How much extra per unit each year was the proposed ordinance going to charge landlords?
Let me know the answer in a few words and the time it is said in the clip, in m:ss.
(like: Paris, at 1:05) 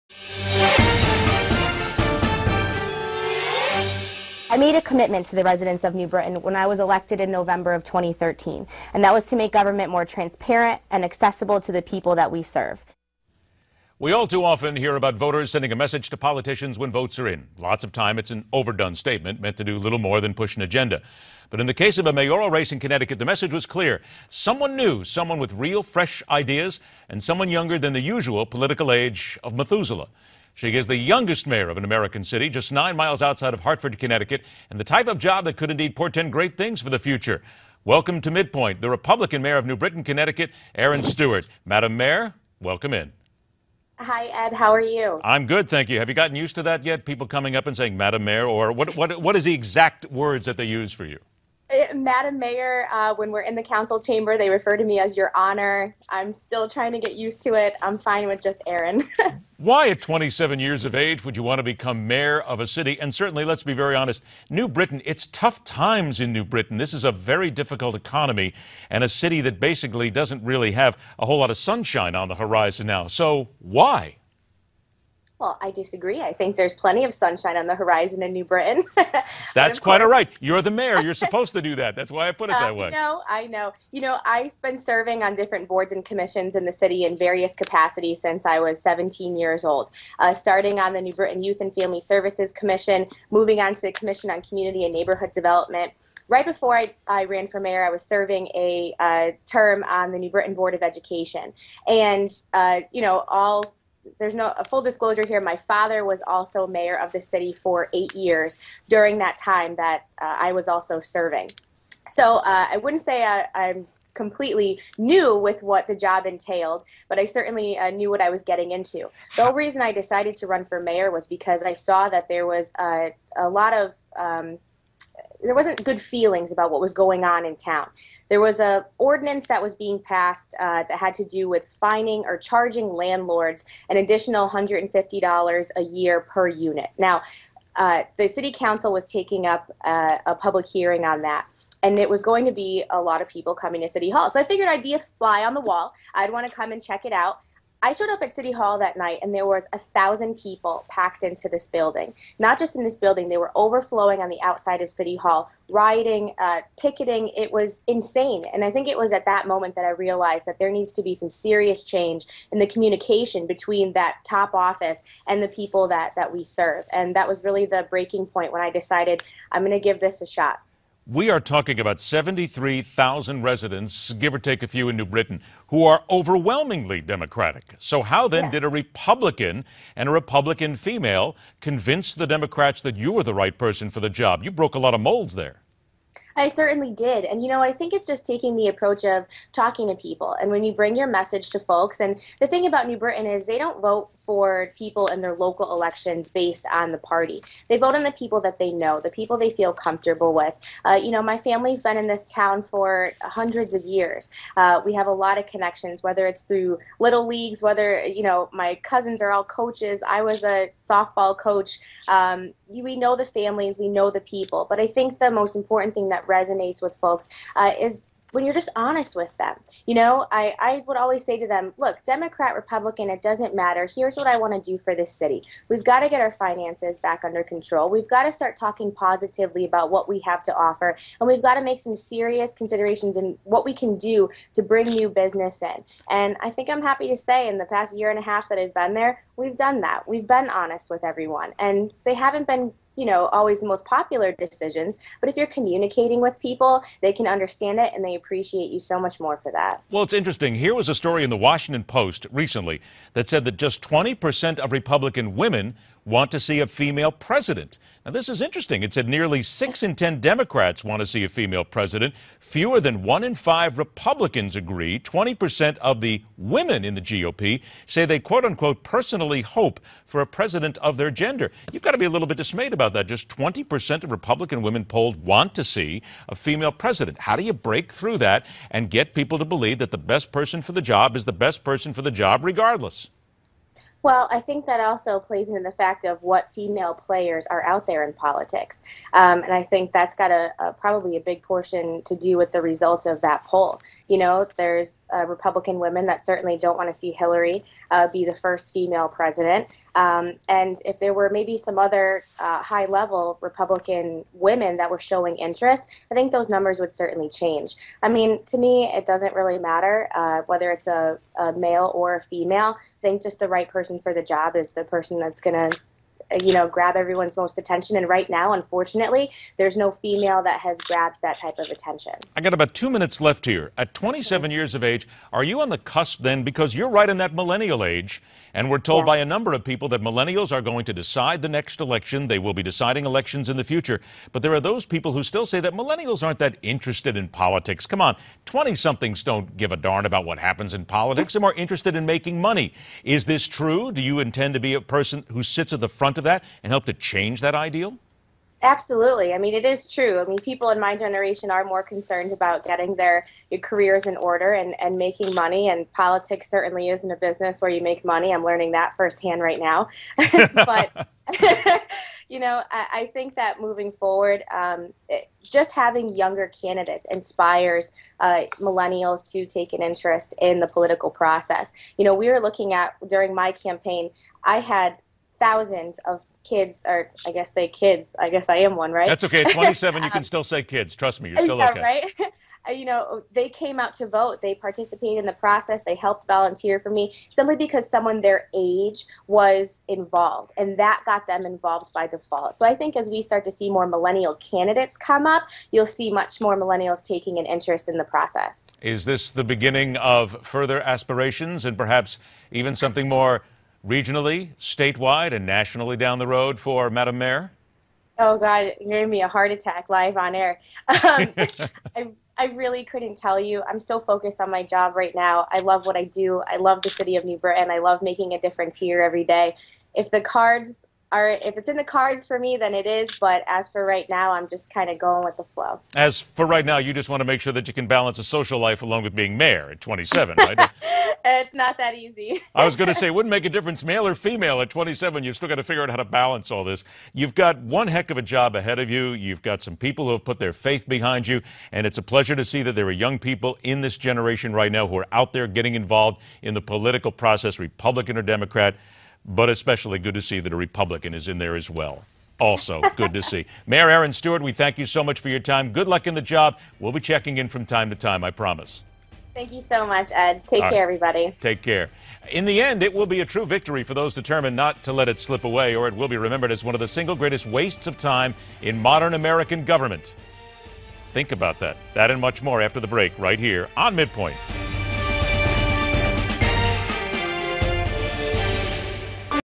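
$150, at 2:14.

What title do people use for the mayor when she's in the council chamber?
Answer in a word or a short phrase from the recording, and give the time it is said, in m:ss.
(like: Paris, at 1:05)
Your Honor, at 0:55.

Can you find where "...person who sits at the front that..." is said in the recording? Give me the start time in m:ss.
5:44.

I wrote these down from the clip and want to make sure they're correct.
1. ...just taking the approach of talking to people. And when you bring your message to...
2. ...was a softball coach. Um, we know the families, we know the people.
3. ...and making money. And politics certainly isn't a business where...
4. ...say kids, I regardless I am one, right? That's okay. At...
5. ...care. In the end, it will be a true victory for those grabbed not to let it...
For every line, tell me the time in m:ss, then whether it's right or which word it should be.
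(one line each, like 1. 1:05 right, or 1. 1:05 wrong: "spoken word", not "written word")
1. 3:08 right
2. 3:30 right
3. 5:54 right
4. 6:17 wrong: "guess", not "regardless"
5. 7:41 wrong: "determined", not "grabbed".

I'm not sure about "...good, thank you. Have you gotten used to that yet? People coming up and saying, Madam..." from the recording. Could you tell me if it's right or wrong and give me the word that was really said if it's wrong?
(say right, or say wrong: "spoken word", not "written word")
right.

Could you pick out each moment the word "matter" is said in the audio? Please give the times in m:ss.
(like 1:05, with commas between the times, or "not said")
3:43, 5:09.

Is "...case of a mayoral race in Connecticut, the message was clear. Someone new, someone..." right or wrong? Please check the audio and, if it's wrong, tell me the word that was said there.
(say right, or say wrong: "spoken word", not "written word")
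right.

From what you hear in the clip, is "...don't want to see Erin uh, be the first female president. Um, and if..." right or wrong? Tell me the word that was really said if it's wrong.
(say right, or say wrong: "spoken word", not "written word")
wrong: "Hillary", not "Erin".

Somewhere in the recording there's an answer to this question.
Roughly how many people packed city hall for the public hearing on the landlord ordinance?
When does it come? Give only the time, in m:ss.
2:29.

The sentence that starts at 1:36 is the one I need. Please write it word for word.
Right before I, I ran for mayor, I was serving a uh, term on the New Britain Board of Education.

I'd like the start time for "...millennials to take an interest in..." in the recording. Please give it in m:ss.
6:08.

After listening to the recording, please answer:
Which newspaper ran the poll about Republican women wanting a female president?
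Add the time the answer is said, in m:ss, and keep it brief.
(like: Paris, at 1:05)
The Washington Post, at 4:11.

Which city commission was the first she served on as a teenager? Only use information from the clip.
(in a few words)
New Britain Youth and Family Services Commission.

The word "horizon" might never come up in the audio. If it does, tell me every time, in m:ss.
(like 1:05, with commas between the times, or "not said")
1:12, 1:17.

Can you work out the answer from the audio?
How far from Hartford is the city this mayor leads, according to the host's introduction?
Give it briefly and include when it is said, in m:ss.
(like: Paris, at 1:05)
9 miles, at 0:32.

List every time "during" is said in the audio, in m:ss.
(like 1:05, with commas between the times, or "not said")
1:48, 6:13.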